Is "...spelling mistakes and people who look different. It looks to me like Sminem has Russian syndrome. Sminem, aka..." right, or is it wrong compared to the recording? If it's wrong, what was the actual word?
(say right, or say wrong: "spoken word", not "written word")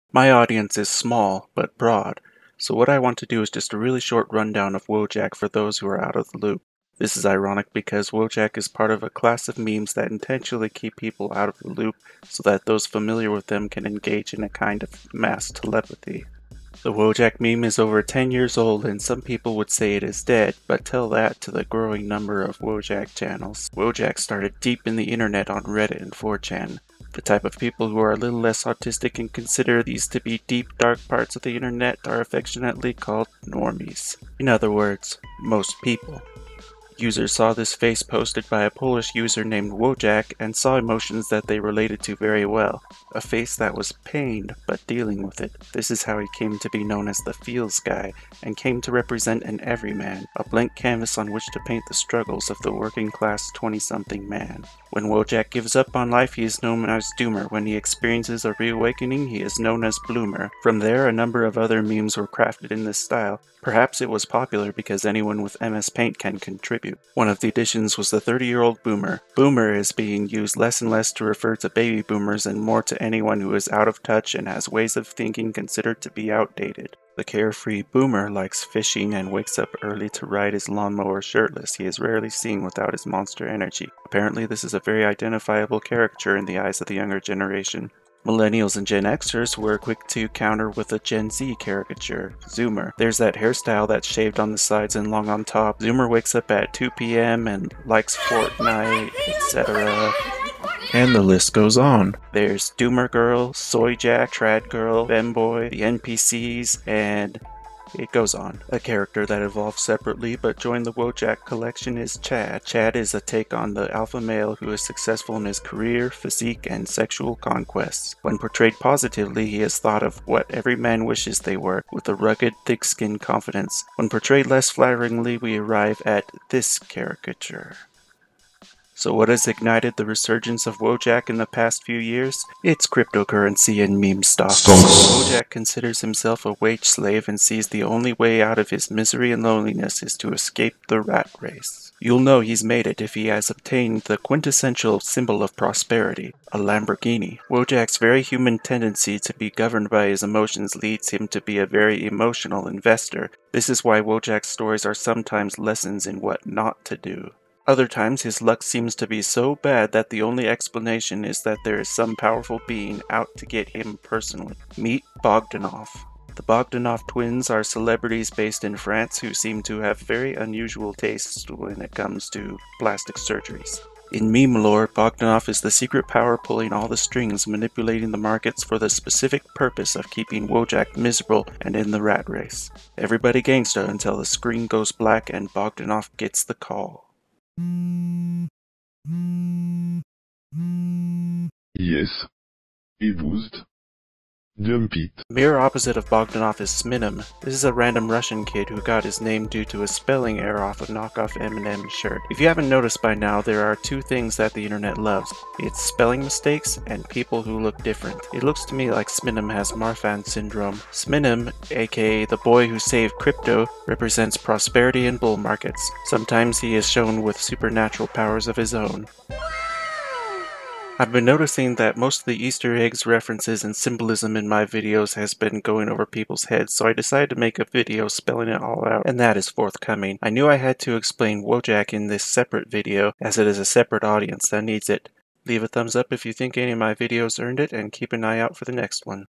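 wrong: "Marfan", not "Russian".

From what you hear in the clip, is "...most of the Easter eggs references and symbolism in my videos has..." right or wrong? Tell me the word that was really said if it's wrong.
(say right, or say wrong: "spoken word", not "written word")
right.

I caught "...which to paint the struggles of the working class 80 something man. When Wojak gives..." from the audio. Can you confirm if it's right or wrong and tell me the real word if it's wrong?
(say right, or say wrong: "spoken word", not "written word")
wrong: "20", not "80".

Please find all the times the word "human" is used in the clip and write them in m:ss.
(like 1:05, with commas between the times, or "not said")
2:28.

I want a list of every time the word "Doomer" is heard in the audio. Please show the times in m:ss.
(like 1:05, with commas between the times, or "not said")
0:57, 1:42.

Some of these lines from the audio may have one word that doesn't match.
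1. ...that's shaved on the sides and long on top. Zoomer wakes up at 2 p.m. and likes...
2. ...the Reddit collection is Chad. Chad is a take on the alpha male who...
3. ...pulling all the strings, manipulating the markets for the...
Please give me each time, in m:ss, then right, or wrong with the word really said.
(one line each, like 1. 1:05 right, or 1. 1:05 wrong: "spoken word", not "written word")
1. 1:33 right
2. 1:50 wrong: "Wojak", not "Reddit"
3. 2:56 right.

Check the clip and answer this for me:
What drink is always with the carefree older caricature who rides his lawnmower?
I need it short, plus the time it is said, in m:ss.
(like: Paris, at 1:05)
Monster energy, at 1:23.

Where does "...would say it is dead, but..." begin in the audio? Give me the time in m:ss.
0:19.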